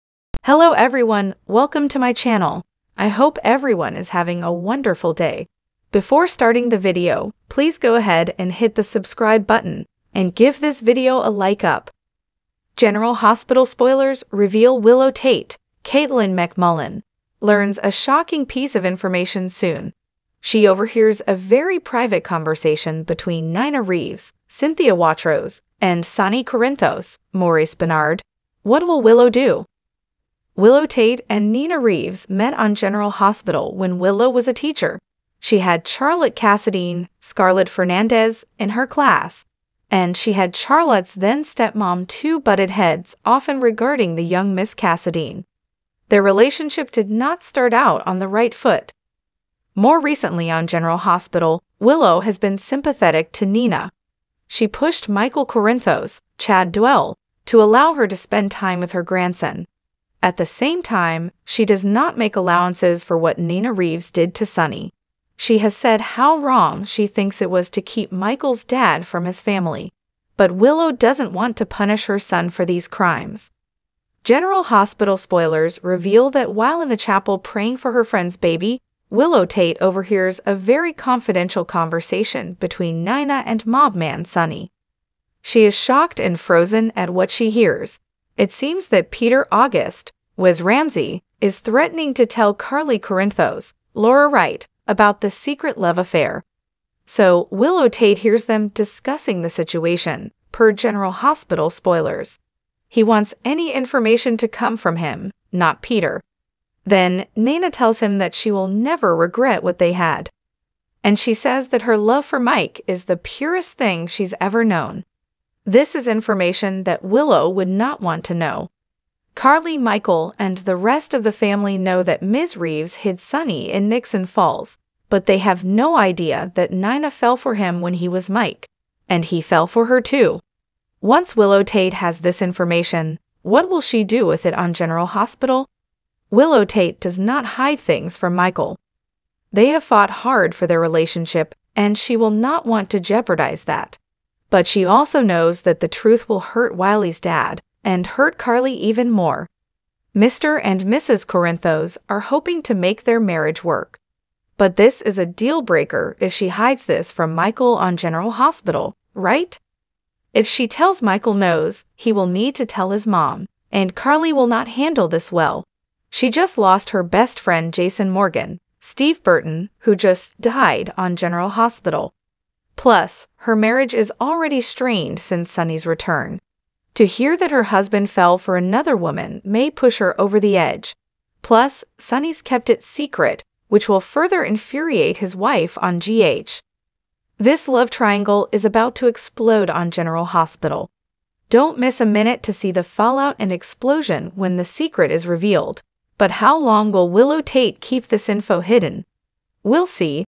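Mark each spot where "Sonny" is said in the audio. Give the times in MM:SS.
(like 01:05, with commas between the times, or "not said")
00:26, 01:04, 01:24, 02:03, 02:55, 03:01.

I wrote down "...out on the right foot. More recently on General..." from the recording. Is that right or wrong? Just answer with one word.
right.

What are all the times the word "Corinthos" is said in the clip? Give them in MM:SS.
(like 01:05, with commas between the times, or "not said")
00:26, 00:55, 01:32, 02:31.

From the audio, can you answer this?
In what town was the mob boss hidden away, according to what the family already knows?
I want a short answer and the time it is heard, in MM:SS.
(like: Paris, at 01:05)
Nixon Falls, at 02:03.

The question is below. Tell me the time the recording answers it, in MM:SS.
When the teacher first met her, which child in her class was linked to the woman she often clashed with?
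00:35.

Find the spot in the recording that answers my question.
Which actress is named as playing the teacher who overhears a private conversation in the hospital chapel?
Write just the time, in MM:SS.
00:15.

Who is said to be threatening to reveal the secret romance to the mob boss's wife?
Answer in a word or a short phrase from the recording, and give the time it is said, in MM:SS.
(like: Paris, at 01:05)
Peter August, at 01:29.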